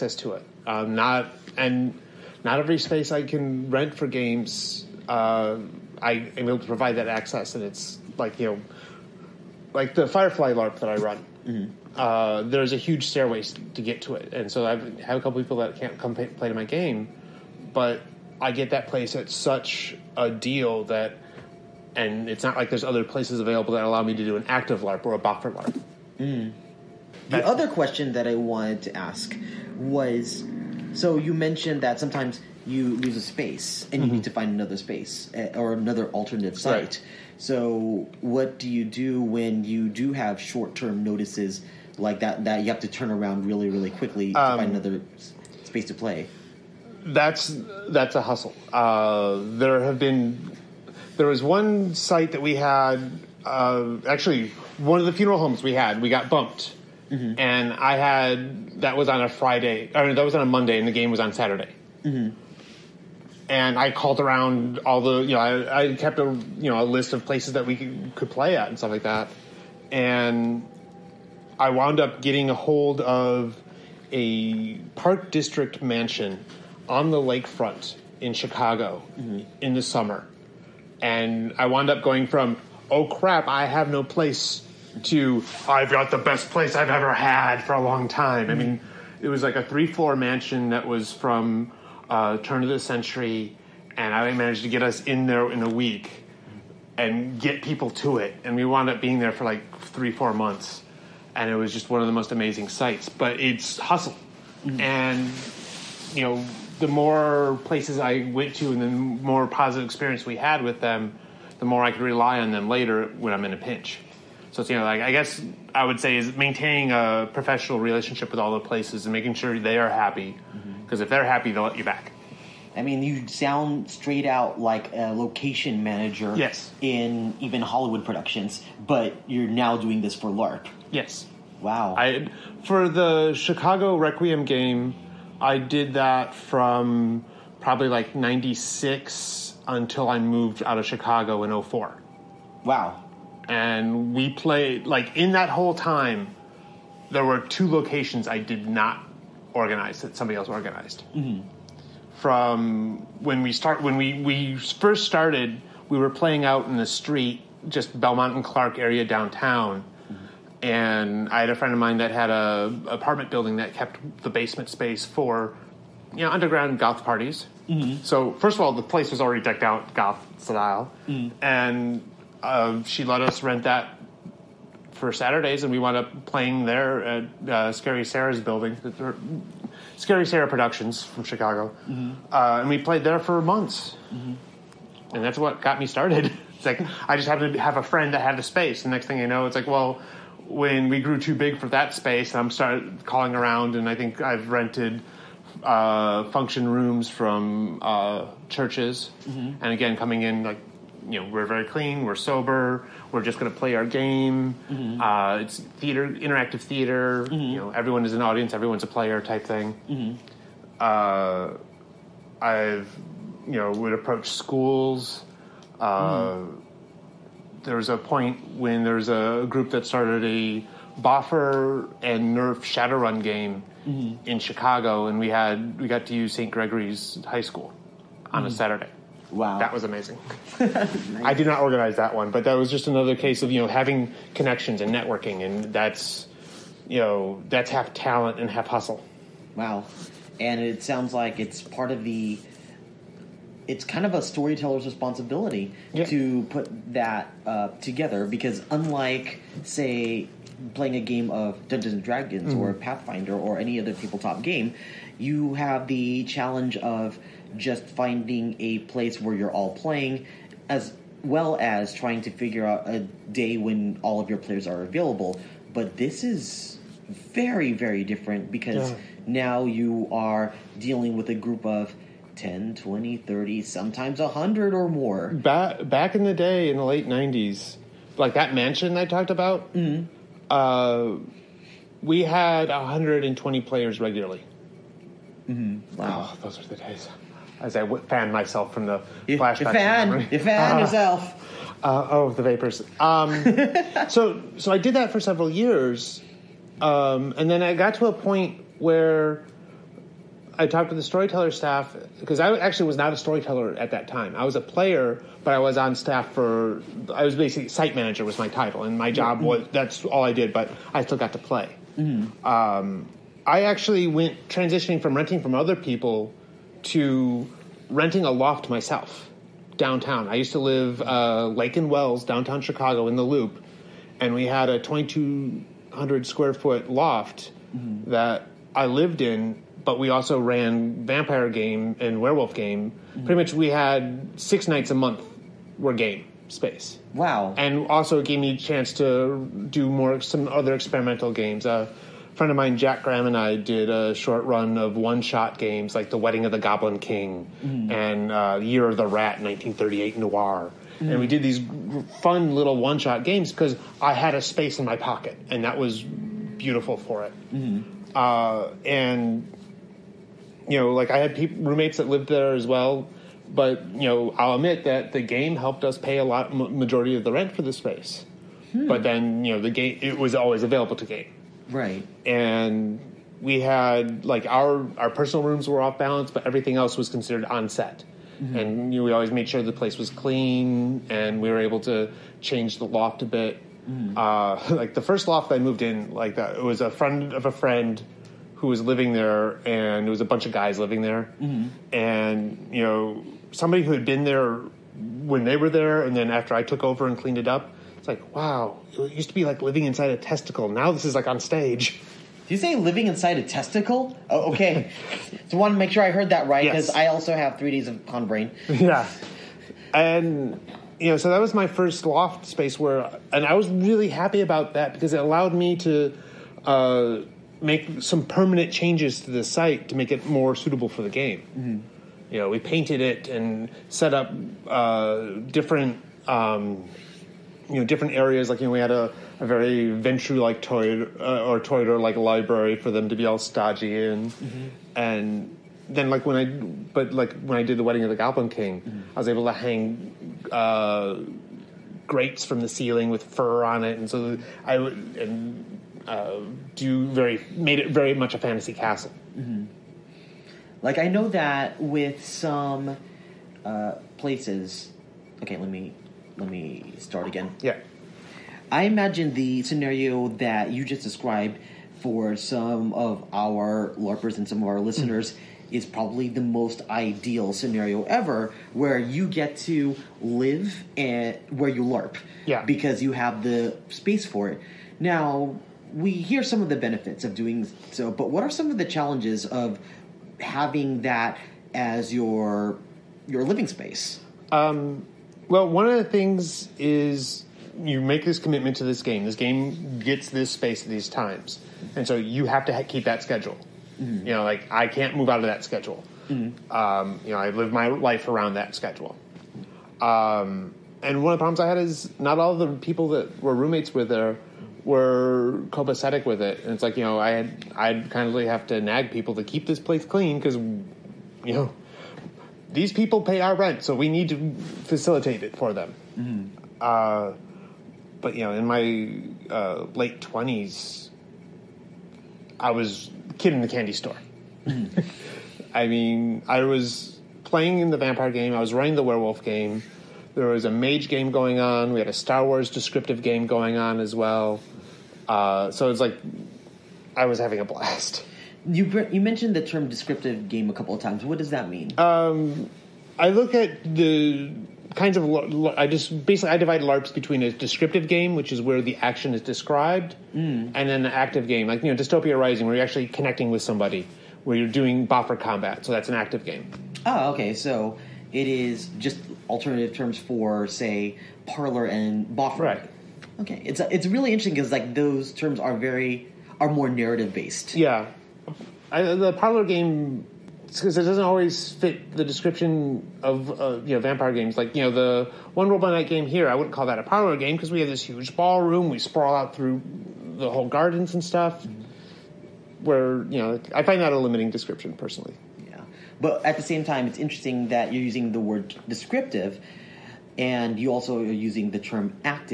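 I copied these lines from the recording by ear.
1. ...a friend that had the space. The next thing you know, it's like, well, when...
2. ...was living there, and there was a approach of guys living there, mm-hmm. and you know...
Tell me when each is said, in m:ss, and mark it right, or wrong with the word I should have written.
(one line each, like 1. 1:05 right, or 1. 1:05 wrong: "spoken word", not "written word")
1. 3:07 right
2. 6:28 wrong: "bunch", not "approach".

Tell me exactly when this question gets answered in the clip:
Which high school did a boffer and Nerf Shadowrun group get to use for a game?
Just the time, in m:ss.
3:46.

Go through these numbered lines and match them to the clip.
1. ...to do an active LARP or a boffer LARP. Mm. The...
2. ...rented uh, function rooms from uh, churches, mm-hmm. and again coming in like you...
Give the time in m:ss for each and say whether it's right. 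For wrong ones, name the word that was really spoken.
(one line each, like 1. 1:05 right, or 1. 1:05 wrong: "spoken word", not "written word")
1. 0:24 right
2. 3:14 right.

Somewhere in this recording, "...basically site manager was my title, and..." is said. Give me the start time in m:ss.
5:07.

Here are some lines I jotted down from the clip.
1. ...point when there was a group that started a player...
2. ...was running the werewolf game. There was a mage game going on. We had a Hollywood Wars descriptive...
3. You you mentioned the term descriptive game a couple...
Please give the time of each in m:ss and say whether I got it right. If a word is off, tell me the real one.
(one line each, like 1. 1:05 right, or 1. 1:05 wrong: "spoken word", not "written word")
1. 3:37 wrong: "boffer", not "player"
2. 8:48 wrong: "Star", not "Hollywood"
3. 8:58 right.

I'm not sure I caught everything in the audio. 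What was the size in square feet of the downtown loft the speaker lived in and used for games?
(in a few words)
2,200.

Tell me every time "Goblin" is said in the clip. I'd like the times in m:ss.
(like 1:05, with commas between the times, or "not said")
5:46, 7:18.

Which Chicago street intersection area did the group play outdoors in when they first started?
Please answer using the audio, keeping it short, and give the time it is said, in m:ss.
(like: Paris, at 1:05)
Belmont and Clark, at 2:37.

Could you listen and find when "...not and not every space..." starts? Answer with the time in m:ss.
0:00.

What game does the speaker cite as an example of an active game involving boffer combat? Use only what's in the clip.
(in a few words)
Dystopia Rising.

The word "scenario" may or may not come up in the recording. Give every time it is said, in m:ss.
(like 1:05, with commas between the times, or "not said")
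7:39, 7:47.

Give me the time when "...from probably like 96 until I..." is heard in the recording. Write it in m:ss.
2:16.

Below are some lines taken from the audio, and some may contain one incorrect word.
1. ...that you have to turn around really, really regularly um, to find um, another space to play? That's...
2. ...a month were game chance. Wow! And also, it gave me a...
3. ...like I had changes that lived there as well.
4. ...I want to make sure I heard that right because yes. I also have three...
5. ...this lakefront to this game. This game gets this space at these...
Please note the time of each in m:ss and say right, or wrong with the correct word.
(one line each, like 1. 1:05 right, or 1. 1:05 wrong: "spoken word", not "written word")
1. 0:42 wrong: "quickly", not "regularly"
2. 5:34 wrong: "space", not "chance"
3. 6:00 wrong: "roommates", not "changes"
4. 6:45 right
5. 8:08 wrong: "commitment", not "lakefront".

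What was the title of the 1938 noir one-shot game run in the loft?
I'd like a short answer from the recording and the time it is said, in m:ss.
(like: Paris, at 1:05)
Year of the Rat, at 5:48.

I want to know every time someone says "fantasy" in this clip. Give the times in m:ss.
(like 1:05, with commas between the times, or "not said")
7:28.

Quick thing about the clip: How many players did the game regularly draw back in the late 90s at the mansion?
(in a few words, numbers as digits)
120.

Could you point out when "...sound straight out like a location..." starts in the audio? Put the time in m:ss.
2:03.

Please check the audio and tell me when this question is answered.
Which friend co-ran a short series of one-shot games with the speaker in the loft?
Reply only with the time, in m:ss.
5:42.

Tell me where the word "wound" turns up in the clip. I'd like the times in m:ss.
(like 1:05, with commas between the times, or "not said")
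1:11, 1:21, 1:38, 2:55.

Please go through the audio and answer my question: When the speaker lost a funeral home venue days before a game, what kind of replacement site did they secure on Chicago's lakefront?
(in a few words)
Park District mansion.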